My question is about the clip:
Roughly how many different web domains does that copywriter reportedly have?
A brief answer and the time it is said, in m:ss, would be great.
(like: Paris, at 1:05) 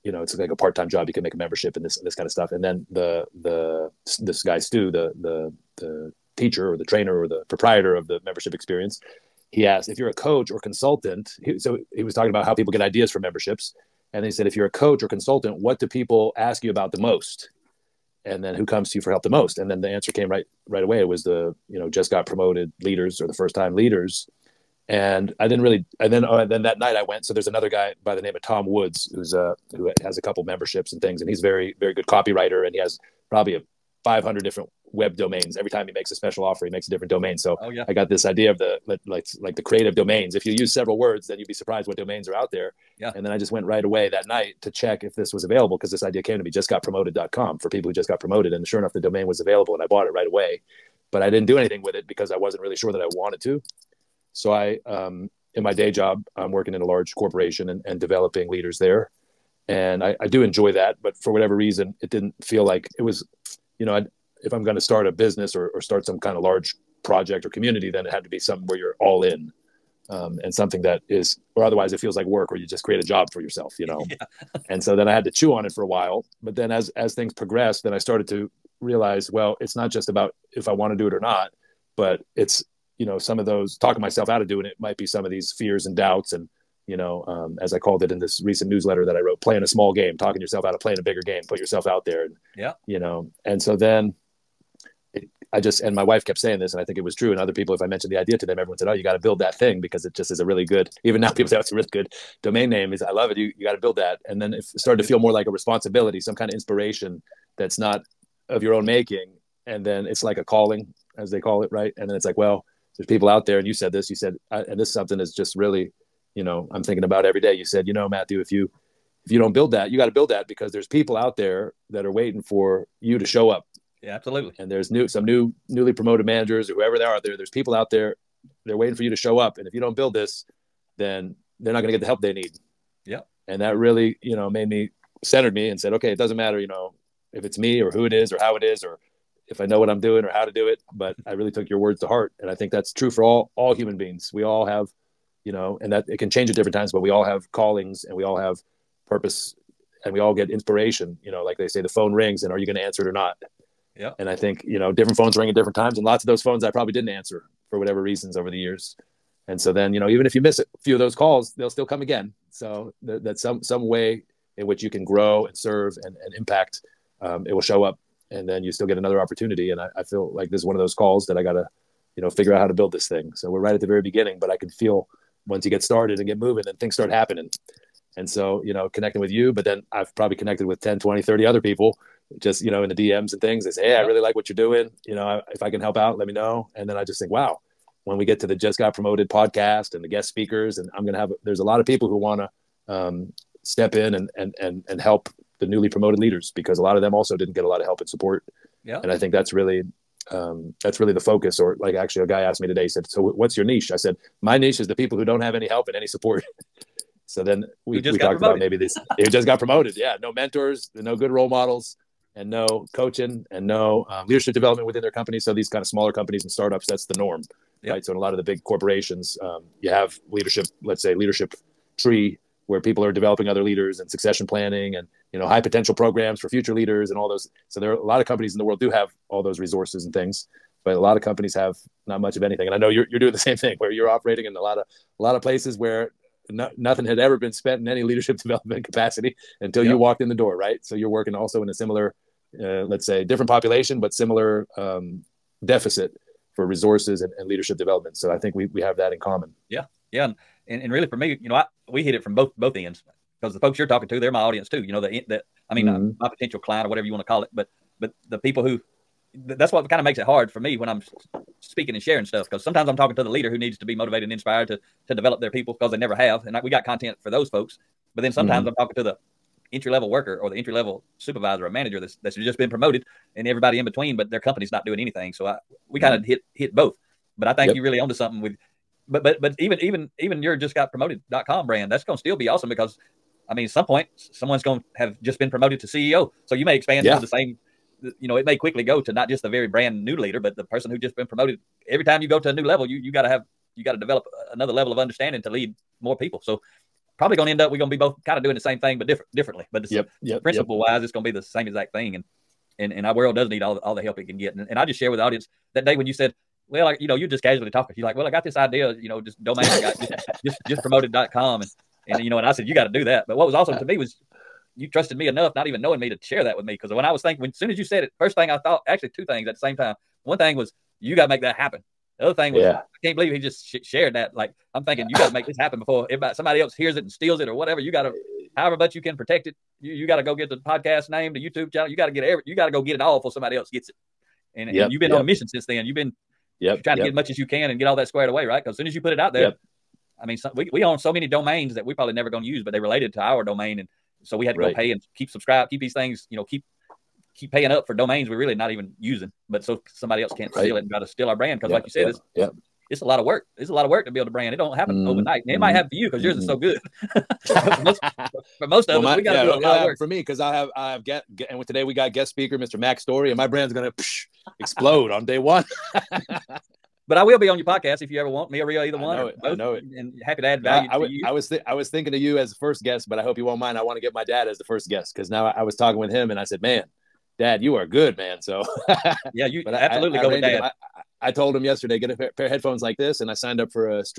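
500, at 0:34.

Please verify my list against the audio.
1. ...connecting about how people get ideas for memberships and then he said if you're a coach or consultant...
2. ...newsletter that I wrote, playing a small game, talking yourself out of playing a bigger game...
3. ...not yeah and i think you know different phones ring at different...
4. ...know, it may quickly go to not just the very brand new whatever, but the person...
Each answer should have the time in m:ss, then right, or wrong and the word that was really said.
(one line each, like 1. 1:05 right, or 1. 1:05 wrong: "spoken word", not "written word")
1. 0:12 wrong: "talking", not "connecting"
2. 1:28 right
3. 2:33 right
4. 4:48 wrong: "leader", not "whatever".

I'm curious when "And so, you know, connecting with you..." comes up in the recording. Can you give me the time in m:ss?
2:58.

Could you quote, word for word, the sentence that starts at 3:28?
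about maybe this it just got promoted.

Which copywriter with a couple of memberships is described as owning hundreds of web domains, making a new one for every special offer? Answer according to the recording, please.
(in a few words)
Tom Woods.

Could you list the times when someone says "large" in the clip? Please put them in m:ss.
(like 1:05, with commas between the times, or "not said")
0:56, 1:06.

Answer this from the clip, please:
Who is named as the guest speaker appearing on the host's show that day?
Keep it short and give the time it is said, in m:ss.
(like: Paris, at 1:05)
Mack Story, at 6:02.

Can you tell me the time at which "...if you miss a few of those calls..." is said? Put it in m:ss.
2:40.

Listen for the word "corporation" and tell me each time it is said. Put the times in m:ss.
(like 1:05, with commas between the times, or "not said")
0:57, 3:38.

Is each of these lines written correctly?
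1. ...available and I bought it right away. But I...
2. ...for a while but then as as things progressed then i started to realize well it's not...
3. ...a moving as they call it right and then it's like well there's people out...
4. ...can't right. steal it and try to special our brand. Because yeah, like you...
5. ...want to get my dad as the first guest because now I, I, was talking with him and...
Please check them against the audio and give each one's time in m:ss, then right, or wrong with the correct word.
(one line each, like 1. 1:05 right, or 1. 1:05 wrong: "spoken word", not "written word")
1. 0:49 right
2. 1:15 right
3. 1:50 wrong: "calling", not "moving"
4. 5:50 wrong: "steal", not "special"
5. 6:13 right.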